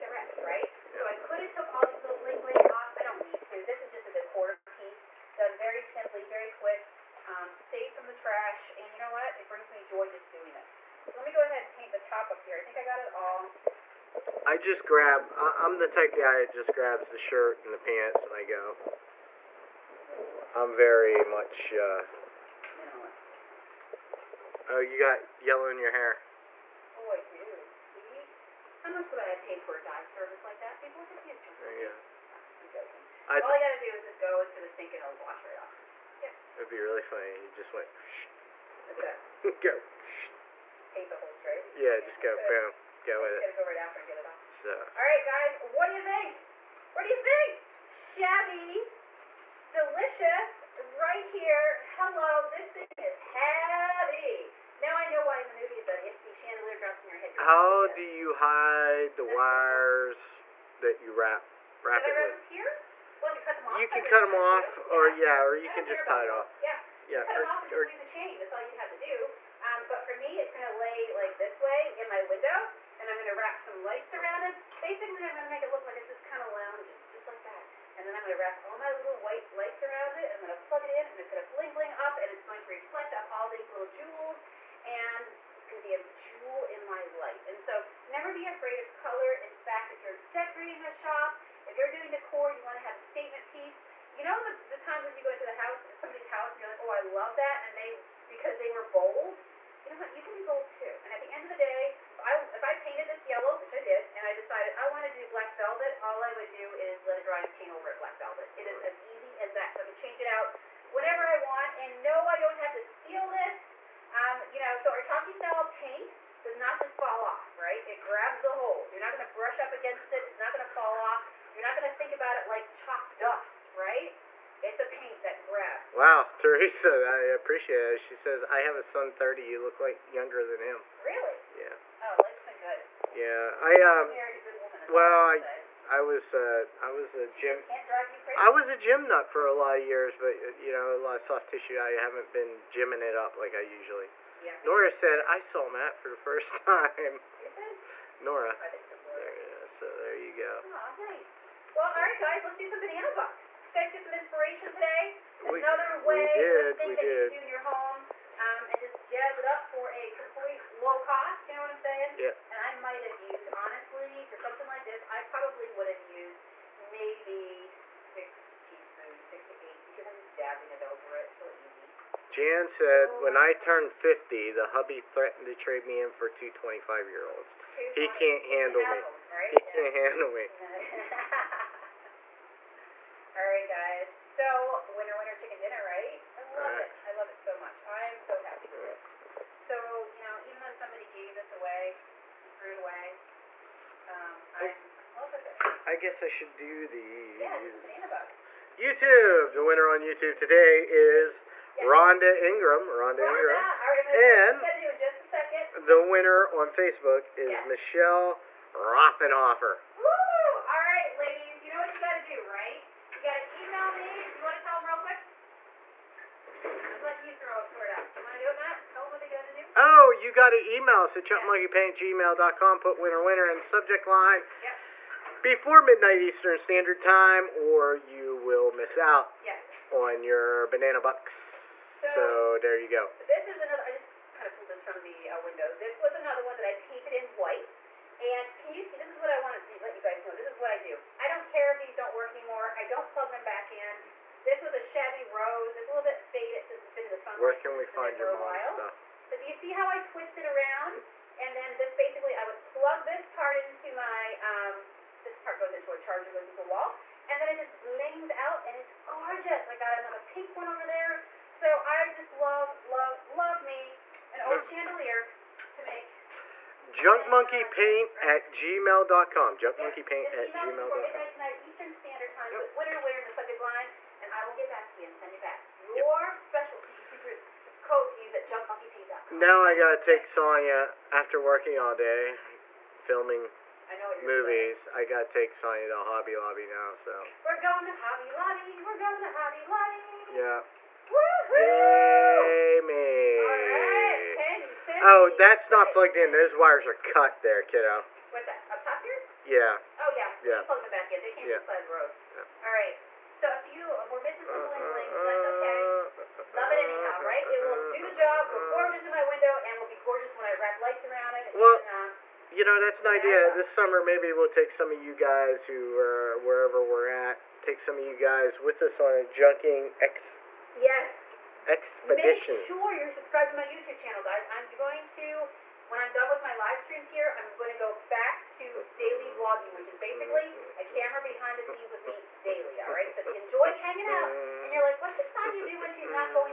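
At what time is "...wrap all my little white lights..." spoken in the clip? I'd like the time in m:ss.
1:18.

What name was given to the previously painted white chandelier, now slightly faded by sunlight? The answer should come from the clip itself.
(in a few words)
shabby rose.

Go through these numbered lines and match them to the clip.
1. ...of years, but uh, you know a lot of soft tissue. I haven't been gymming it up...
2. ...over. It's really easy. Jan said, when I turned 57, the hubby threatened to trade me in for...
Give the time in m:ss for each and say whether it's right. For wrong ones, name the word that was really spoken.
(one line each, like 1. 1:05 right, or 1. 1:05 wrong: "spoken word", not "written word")
1. 2:19 right
2. 2:50 wrong: "50", not "57".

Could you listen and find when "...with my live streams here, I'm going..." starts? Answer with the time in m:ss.
5:26.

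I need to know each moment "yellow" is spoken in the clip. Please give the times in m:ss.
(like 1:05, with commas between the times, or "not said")
0:25, 1:43.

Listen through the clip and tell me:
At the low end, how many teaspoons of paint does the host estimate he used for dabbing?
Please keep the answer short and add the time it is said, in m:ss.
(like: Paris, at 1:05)
6, at 2:47.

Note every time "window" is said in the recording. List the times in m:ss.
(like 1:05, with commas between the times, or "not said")
1:12, 3:55, 5:09.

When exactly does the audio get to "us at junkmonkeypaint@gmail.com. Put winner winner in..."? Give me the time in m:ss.
3:41.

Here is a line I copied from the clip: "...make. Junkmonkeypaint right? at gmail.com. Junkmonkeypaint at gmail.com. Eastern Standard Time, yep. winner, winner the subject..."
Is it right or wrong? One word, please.
right.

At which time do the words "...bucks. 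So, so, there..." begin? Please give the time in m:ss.
3:50.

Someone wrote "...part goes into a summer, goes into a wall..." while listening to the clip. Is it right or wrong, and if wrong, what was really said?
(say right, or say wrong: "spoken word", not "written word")
wrong: "charger", not "summer".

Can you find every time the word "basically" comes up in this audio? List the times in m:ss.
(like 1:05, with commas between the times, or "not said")
1:14, 4:11, 5:29.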